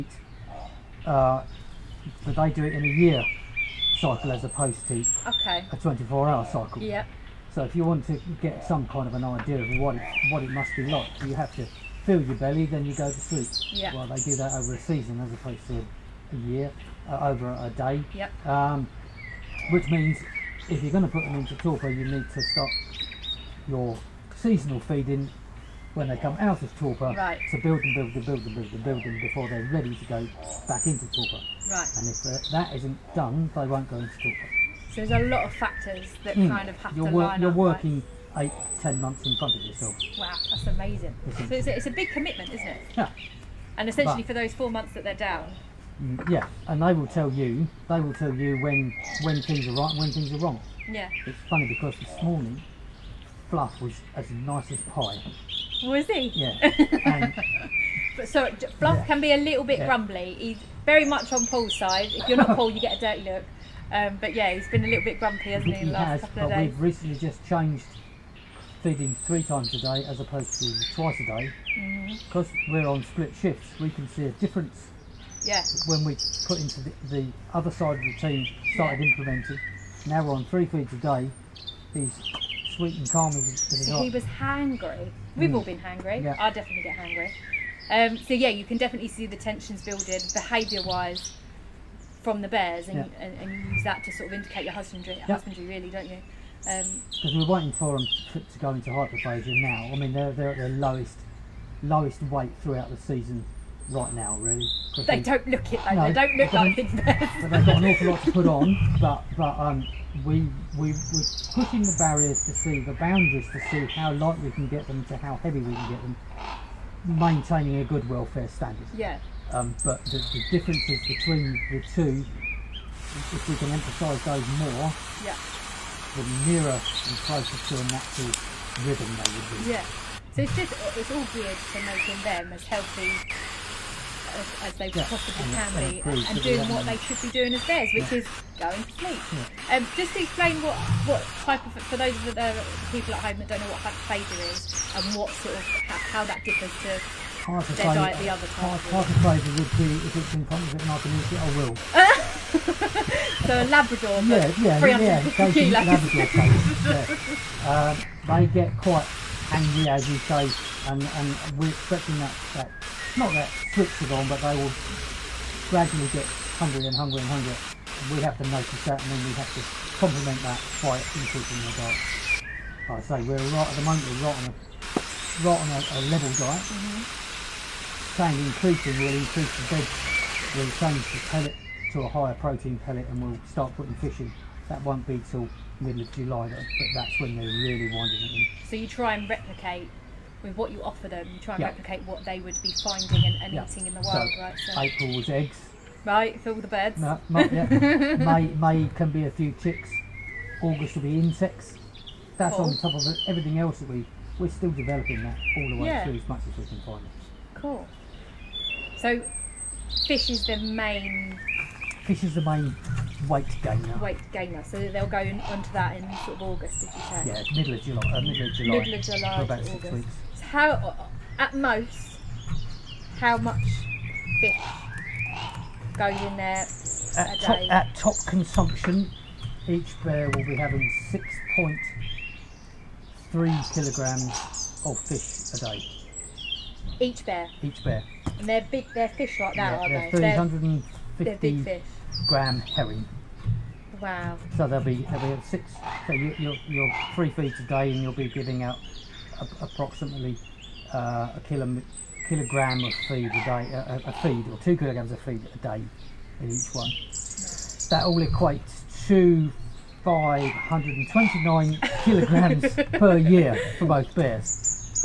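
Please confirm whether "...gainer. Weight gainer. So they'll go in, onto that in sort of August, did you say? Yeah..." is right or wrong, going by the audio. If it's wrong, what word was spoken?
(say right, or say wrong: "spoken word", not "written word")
right.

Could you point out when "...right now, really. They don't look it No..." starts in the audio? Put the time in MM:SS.
01:43.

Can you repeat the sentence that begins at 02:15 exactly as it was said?
possibly can be and, and doing what they should be doing as theirs, which yeah.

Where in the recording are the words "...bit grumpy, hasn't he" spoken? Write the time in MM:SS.
01:05.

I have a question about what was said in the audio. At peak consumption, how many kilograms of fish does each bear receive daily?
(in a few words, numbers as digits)
6.3 kilograms.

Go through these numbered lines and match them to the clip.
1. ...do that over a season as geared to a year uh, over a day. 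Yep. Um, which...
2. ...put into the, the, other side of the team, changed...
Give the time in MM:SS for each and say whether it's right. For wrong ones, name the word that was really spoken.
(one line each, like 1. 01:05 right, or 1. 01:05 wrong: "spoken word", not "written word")
1. 00:14 wrong: "opposed", not "geared"
2. 01:16 wrong: "started", not "changed".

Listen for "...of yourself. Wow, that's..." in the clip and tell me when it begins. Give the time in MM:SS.
00:39.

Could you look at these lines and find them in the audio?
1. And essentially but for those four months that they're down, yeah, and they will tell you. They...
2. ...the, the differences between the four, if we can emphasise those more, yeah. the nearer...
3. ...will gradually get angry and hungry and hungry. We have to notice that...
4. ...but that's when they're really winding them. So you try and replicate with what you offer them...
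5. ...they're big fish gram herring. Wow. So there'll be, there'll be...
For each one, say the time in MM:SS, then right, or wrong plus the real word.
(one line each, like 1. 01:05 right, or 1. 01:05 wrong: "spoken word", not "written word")
1. 00:43 right
2. 02:00 wrong: "two", not "four"
3. 02:44 wrong: "hungry", not "angry"
4. 03:06 right
5. 04:01 right.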